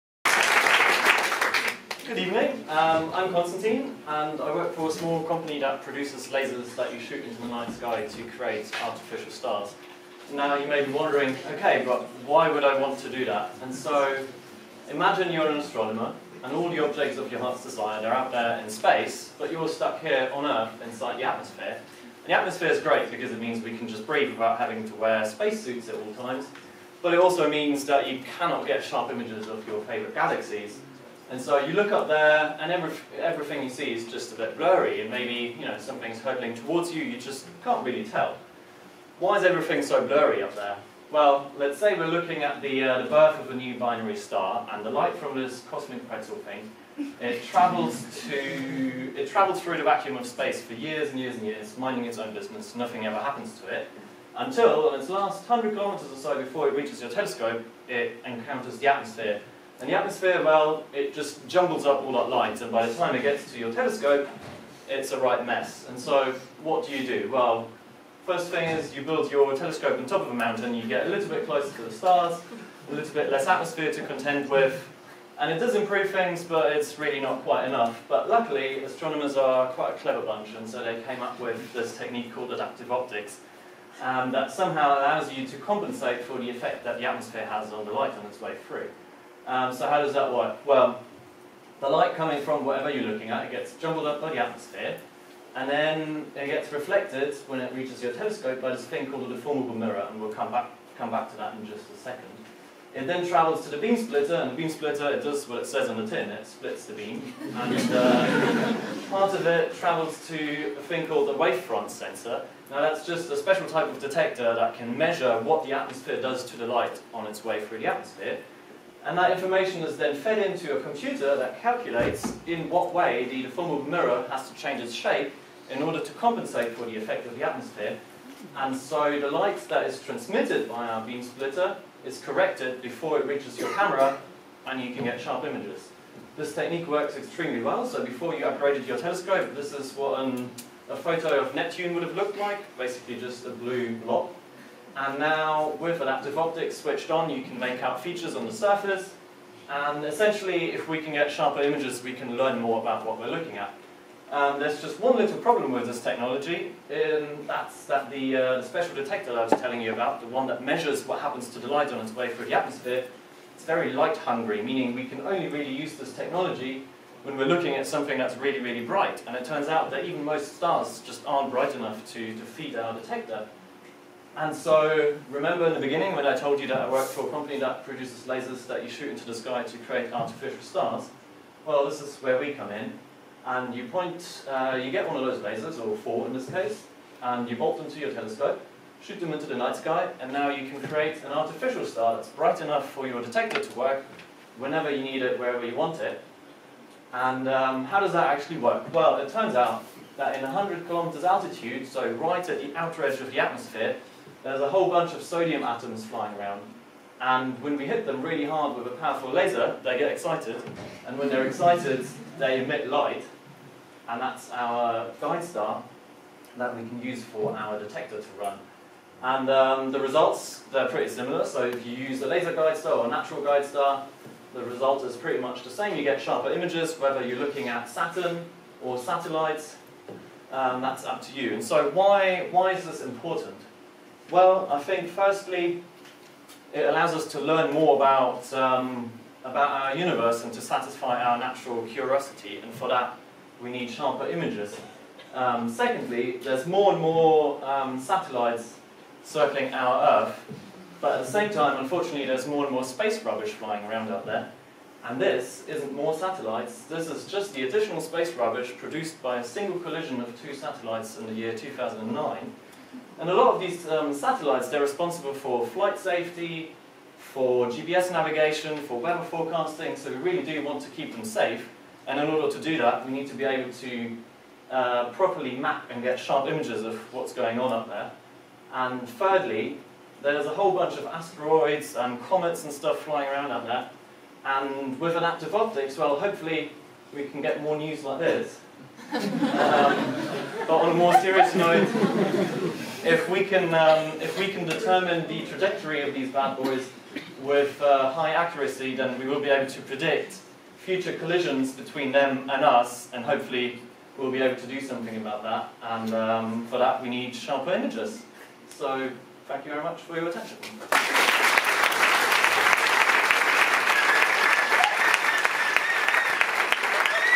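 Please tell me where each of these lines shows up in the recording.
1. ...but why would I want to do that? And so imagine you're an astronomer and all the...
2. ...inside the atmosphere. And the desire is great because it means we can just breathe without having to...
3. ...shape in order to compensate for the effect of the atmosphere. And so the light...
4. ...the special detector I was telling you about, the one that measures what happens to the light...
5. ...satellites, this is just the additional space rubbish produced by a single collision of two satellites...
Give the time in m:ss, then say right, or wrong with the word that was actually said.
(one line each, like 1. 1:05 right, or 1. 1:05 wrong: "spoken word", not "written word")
1. 0:11 right
2. 0:20 wrong: "atmosphere", not "desire"
3. 2:04 right
4. 2:38 right
5. 4:16 right.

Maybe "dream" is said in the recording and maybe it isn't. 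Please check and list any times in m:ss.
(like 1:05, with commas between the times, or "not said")
not said.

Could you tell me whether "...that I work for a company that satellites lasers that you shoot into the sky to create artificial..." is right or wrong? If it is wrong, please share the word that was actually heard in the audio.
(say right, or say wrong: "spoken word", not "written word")
wrong: "produces", not "satellites".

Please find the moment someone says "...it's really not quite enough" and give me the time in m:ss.
1:16.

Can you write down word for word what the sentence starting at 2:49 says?
And it turns out that even most stars just aren't bright enough to, to feed our detector.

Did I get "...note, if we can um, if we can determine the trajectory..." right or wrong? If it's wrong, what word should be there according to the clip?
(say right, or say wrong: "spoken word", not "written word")
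right.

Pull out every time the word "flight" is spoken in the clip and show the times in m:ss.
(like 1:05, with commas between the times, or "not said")
4:25.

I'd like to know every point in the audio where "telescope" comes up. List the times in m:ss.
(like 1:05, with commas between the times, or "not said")
0:57, 1:03, 1:09, 1:38, 2:18, 3:08.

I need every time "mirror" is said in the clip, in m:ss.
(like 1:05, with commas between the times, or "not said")
1:39, 2:03.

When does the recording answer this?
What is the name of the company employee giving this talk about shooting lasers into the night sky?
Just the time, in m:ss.
0:03.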